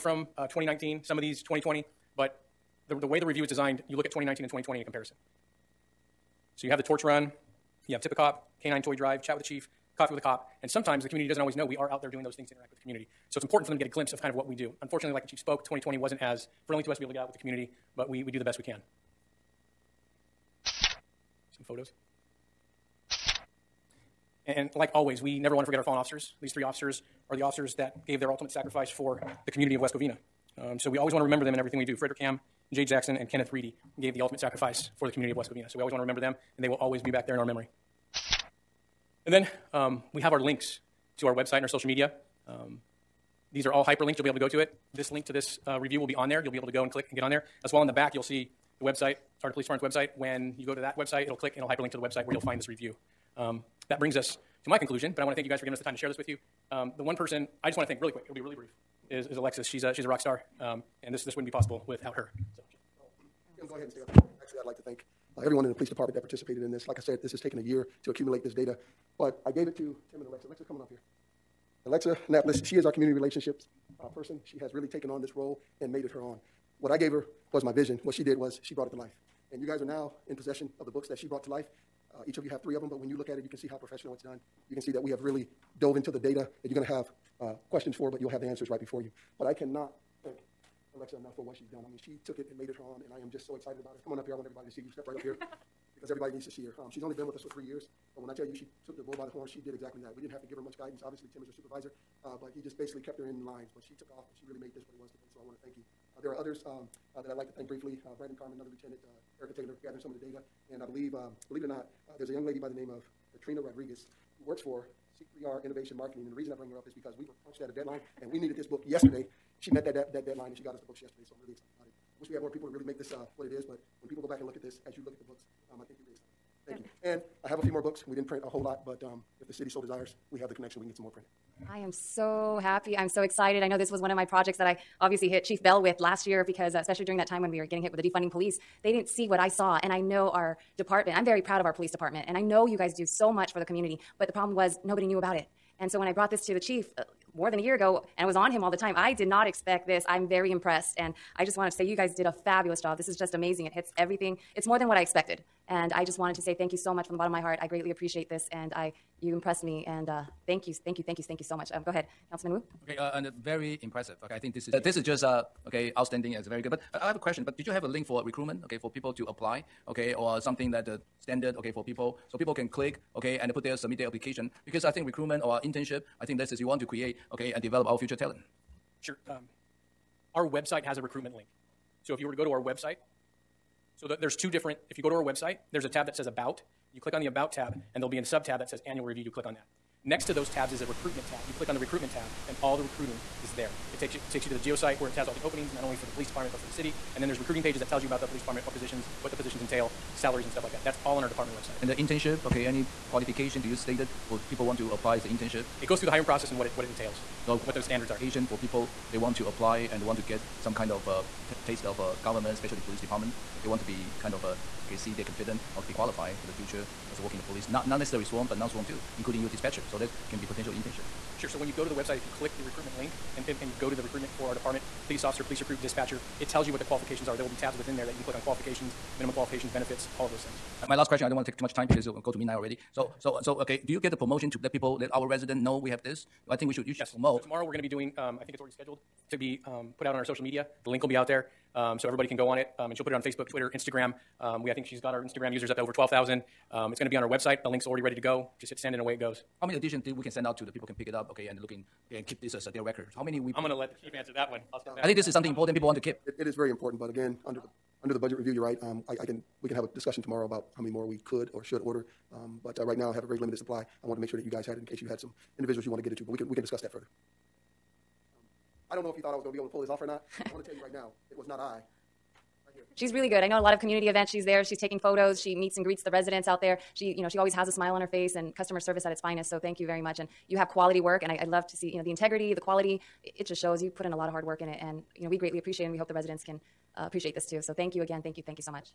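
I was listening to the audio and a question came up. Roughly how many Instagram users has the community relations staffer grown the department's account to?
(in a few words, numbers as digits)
over 12,000.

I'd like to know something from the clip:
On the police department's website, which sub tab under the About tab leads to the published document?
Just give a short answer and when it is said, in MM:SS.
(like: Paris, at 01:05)
Annual Review, at 03:08.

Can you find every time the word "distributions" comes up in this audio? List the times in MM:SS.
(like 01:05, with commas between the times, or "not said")
not said.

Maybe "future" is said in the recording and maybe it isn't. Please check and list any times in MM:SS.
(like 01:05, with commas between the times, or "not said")
02:57, 03:36.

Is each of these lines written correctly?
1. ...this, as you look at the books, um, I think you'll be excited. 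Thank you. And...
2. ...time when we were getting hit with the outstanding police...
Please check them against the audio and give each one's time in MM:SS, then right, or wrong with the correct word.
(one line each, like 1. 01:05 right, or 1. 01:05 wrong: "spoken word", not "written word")
1. 02:04 right
2. 02:17 wrong: "defunding", not "outstanding".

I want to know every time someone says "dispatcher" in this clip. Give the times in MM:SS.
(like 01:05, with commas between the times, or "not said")
03:39, 03:45.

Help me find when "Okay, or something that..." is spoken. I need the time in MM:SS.
02:49.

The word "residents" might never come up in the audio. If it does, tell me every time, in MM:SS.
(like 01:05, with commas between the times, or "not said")
03:55, 04:36, 04:46.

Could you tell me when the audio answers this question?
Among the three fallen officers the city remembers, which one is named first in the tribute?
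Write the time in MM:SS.
00:31.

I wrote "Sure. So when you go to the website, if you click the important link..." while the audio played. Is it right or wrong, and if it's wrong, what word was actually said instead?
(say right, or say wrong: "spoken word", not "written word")
wrong: "recruitment", not "important".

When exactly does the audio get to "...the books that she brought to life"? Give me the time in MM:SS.
01:20.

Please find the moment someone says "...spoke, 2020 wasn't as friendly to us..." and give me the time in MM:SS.
00:15.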